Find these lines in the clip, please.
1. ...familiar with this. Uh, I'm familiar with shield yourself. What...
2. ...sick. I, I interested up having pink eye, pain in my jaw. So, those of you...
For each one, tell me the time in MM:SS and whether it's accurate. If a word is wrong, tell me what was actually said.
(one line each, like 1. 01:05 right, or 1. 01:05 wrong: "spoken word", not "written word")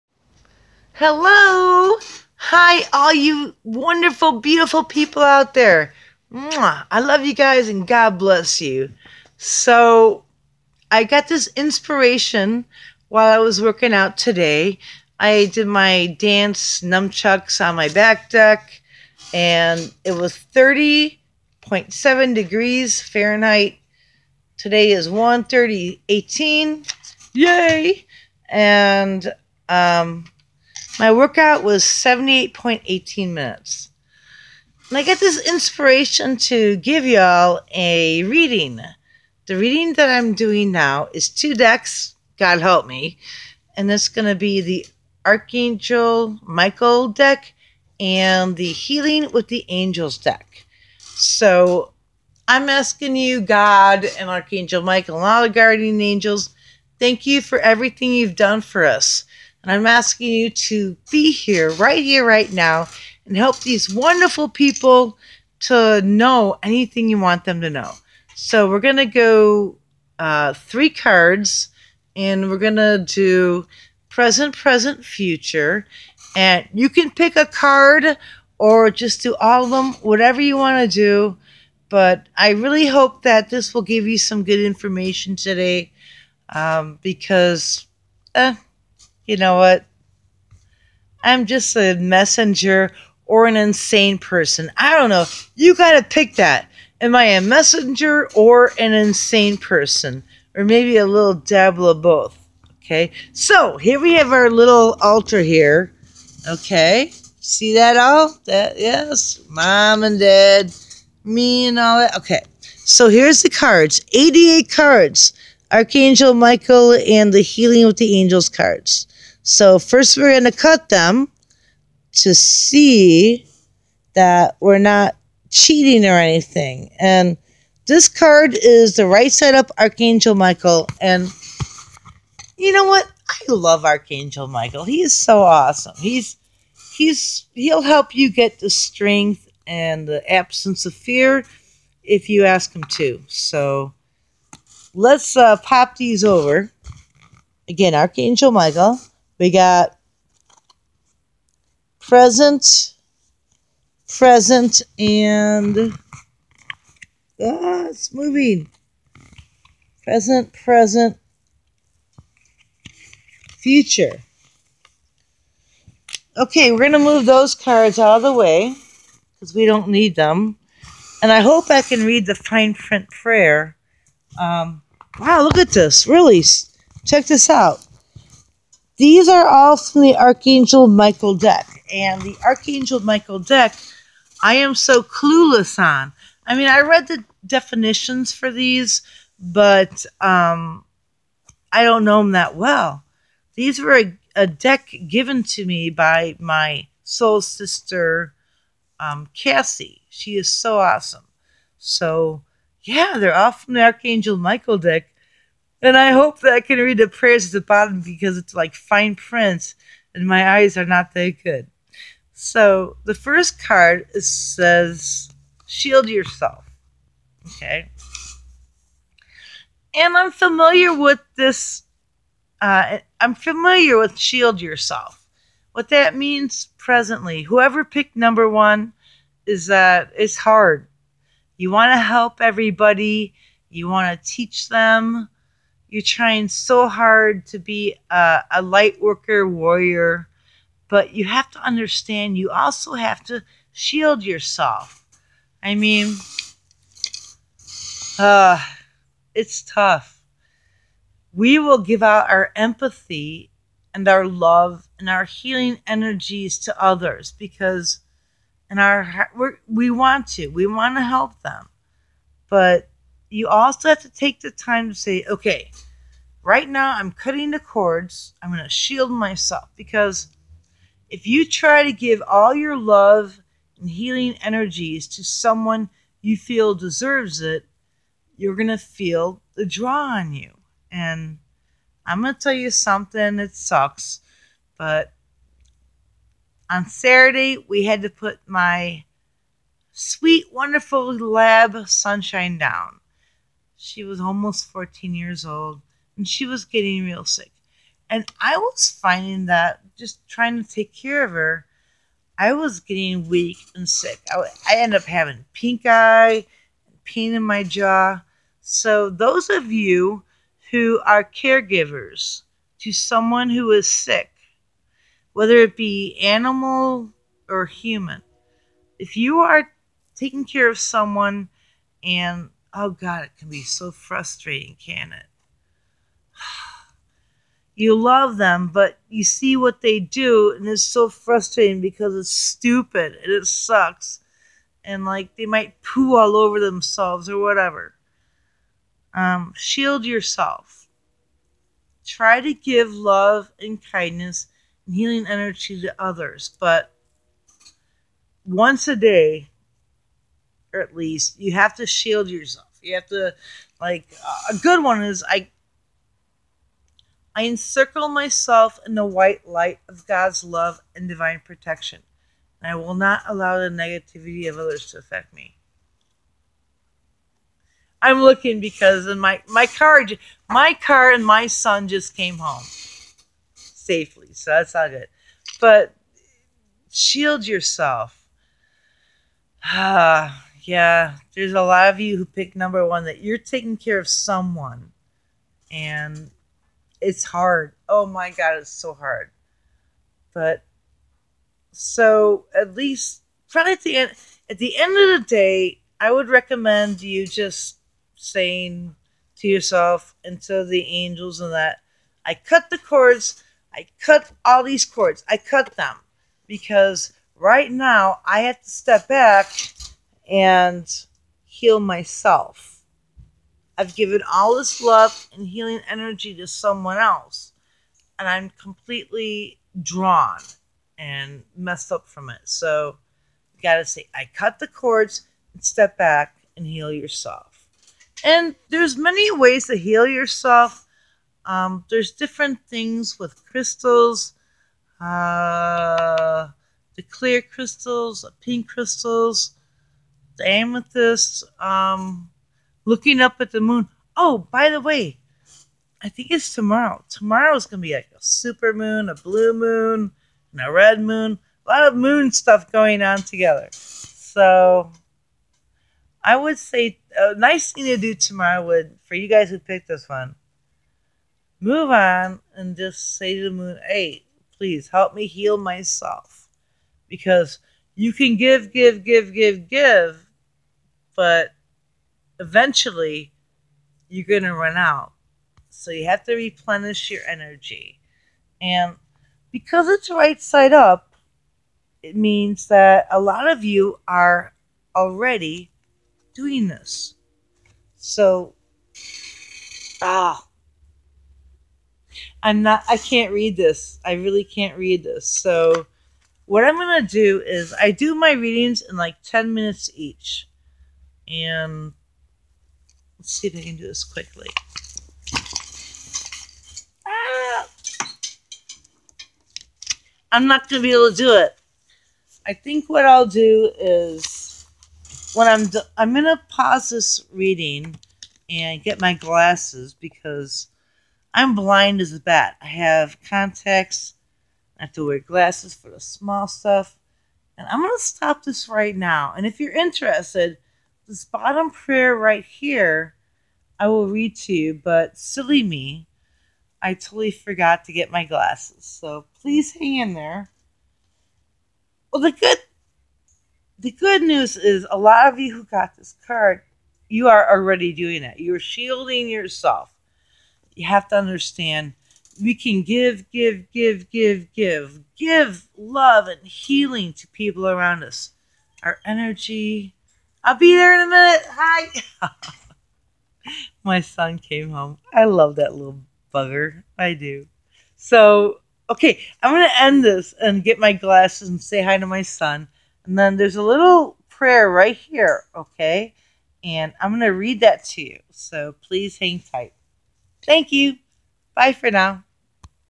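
1. 03:40 right
2. 05:03 wrong: "ended", not "interested".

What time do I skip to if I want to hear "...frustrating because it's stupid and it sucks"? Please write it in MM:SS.
05:31.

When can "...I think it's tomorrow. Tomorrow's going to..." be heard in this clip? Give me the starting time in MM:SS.
07:26.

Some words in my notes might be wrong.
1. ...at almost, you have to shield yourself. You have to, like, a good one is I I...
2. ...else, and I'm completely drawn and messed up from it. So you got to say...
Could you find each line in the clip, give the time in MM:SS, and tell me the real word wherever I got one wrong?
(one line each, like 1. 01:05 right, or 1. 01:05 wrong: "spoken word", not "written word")
1. 05:50 wrong: "least", not "almost"
2. 06:56 right.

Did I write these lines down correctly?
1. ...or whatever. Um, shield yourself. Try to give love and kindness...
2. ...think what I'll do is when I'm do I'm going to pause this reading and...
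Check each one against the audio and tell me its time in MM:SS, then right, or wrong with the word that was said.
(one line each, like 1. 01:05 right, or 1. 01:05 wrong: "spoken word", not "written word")
1. 05:37 right
2. 08:32 right.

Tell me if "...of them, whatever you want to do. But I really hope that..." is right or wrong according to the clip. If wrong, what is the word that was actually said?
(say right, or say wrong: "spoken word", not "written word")
right.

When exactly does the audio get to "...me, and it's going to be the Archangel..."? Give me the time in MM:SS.
00:42.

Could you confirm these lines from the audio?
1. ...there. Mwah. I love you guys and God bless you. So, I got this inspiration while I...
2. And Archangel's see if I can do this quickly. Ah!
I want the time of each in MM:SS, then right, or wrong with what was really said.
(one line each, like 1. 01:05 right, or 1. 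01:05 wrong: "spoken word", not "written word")
1. 00:05 right
2. 08:21 wrong: "Let", not "Archangel".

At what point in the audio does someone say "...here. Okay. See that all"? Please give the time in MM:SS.
01:45.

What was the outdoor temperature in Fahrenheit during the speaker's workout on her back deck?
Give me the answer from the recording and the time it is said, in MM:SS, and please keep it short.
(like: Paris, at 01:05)
30.7 degrees, at 00:20.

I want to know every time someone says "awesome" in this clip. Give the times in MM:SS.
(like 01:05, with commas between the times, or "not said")
02:15, 03:20.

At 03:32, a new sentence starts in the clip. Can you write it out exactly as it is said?
So the first card says, Shield yourself.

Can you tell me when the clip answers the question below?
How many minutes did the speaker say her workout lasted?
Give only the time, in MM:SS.
00:31.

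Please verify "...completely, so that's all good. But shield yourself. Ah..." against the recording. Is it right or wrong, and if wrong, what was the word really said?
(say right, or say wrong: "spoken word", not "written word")
wrong: "safely", not "completely".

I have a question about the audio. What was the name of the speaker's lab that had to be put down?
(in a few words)
Sunshine.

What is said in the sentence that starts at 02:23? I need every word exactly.
So let's uh, pop these over.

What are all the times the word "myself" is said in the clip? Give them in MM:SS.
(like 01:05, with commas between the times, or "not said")
04:29, 05:58, 06:51, 07:45.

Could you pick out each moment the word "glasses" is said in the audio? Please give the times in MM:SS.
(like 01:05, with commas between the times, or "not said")
08:39, 08:45, 08:58, 09:30.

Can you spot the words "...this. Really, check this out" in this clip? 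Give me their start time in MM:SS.
02:55.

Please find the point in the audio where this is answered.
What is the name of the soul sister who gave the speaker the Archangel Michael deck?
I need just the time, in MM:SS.
03:19.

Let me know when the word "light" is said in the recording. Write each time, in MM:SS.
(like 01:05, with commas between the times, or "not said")
03:58, 05:59.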